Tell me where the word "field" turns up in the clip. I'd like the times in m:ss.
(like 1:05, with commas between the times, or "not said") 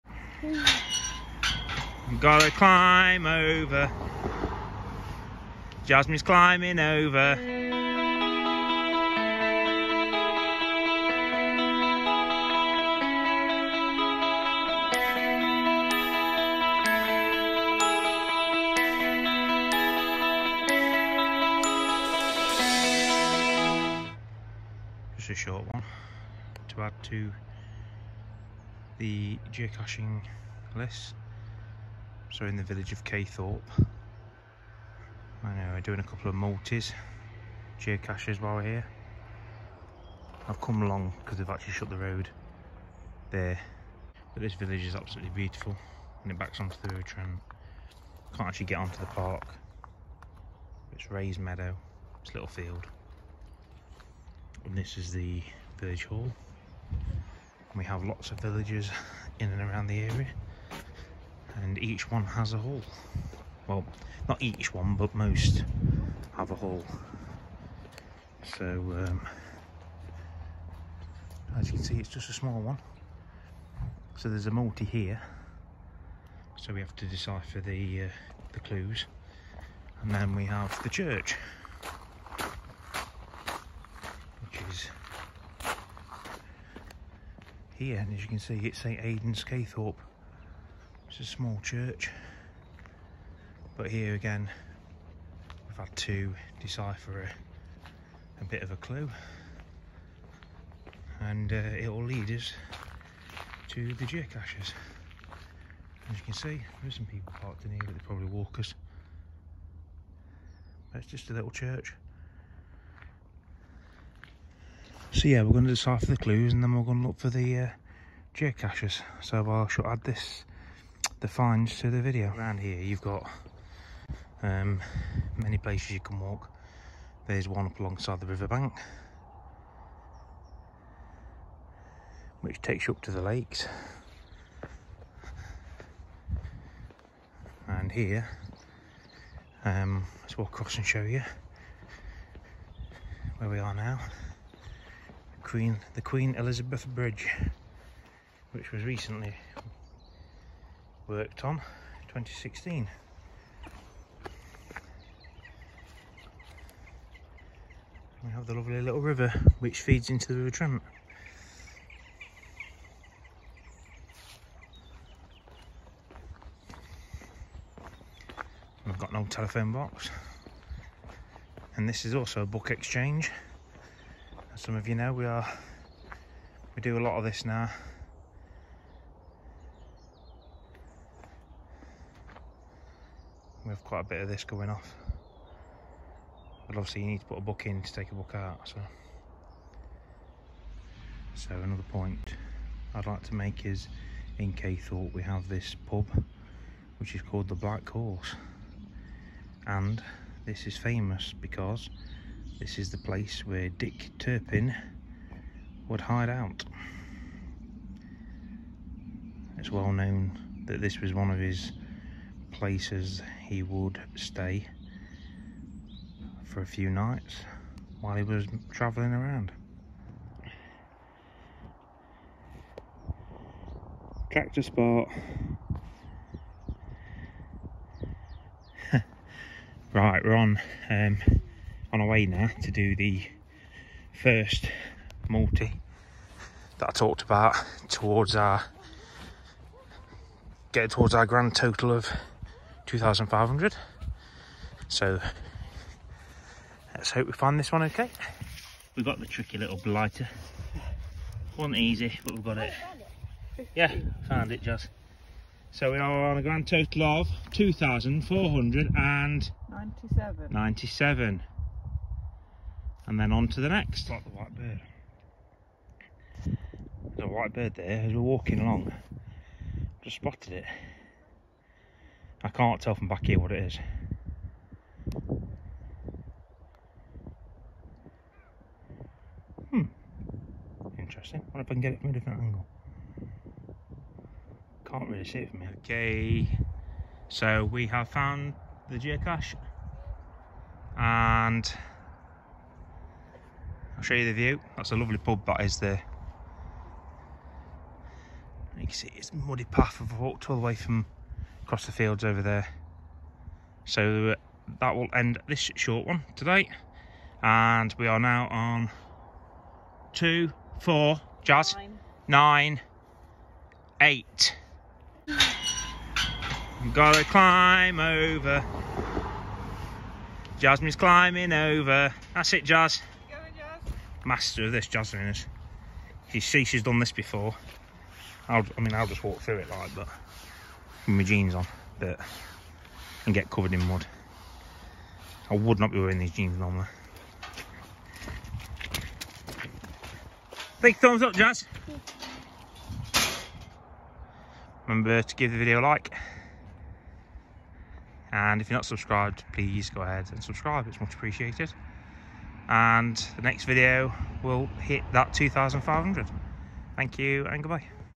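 0:52, 5:01.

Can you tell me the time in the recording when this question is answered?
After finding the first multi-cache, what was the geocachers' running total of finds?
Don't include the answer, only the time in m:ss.
4:17.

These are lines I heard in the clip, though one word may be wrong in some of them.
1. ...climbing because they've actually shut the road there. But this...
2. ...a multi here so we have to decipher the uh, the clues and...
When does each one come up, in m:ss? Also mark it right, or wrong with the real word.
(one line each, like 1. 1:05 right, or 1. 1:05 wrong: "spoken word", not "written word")
1. 0:40 wrong: "along", not "climbing"
2. 1:14 right.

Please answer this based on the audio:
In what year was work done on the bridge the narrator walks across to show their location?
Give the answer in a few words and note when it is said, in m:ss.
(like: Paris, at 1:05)
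2016, at 2:32.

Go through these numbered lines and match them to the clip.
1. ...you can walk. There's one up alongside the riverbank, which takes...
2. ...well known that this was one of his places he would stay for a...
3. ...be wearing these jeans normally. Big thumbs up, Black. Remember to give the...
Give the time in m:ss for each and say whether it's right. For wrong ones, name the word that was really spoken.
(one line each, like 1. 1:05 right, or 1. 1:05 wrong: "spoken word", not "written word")
1. 2:05 right
2. 3:29 right
3. 5:35 wrong: "Jazz", not "Black".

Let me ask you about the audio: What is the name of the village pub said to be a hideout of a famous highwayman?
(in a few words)
The Black Horse.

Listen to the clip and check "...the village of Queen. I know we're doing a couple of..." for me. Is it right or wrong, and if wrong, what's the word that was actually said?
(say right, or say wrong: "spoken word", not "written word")
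wrong: "Caythorpe", not "Queen".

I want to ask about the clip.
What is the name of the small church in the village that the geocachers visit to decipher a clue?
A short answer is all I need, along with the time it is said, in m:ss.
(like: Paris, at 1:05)
St Aidan's, at 1:28.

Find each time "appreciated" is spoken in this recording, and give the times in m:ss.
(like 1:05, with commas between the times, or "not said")
5:51.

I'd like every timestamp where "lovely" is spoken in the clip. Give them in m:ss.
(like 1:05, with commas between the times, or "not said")
2:38, 4:54.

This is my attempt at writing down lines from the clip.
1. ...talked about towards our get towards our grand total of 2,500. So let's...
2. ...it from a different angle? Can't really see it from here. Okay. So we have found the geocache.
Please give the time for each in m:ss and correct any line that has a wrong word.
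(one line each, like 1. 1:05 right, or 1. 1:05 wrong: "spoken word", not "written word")
1. 3:56 right
2. 4:41 right.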